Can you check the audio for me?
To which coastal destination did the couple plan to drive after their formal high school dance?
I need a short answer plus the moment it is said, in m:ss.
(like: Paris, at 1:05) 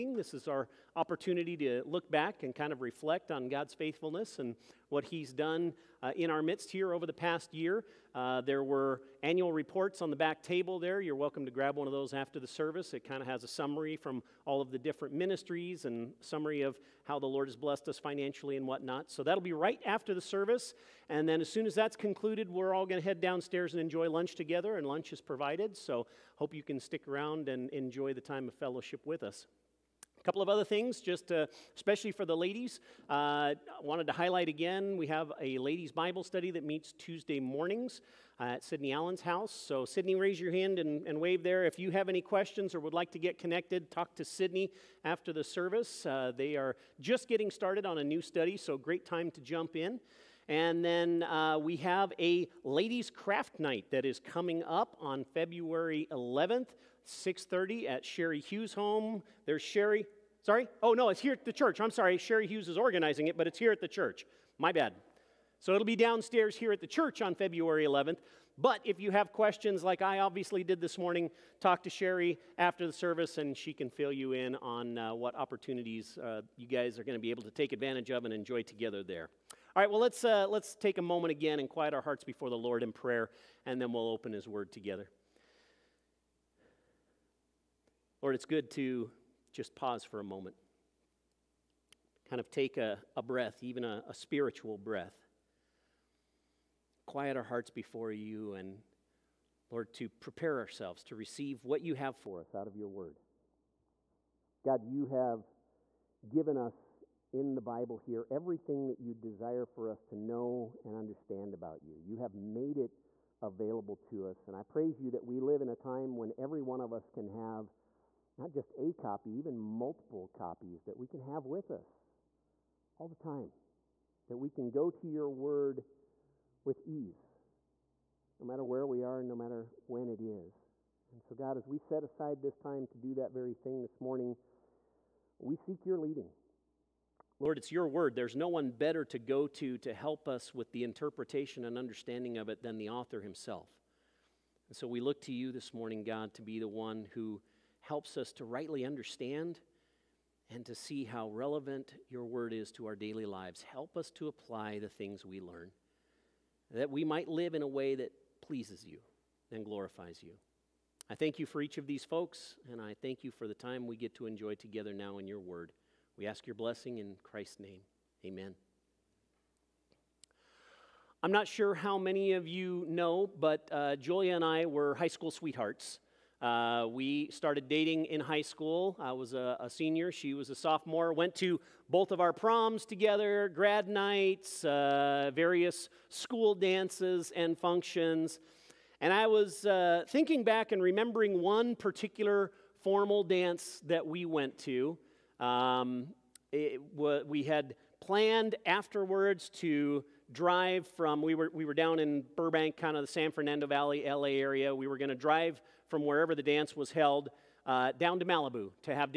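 Malibu, at 3:28.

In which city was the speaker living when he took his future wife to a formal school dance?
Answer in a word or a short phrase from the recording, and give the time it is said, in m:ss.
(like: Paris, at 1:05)
Burbank, at 3:22.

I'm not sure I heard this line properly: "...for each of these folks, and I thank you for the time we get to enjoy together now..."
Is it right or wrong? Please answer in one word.
right.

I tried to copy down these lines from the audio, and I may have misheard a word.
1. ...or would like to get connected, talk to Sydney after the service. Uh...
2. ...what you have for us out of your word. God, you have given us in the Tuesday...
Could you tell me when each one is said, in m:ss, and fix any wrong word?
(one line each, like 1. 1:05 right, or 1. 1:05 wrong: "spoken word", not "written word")
1. 0:42 right
2. 1:41 wrong: "Bible", not "Tuesday".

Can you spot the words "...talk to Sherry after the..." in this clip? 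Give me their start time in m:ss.
1:11.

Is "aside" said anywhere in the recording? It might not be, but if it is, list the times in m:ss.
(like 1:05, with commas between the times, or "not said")
2:12.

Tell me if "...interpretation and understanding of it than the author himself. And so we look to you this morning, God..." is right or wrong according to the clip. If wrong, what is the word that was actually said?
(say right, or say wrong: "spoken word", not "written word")
right.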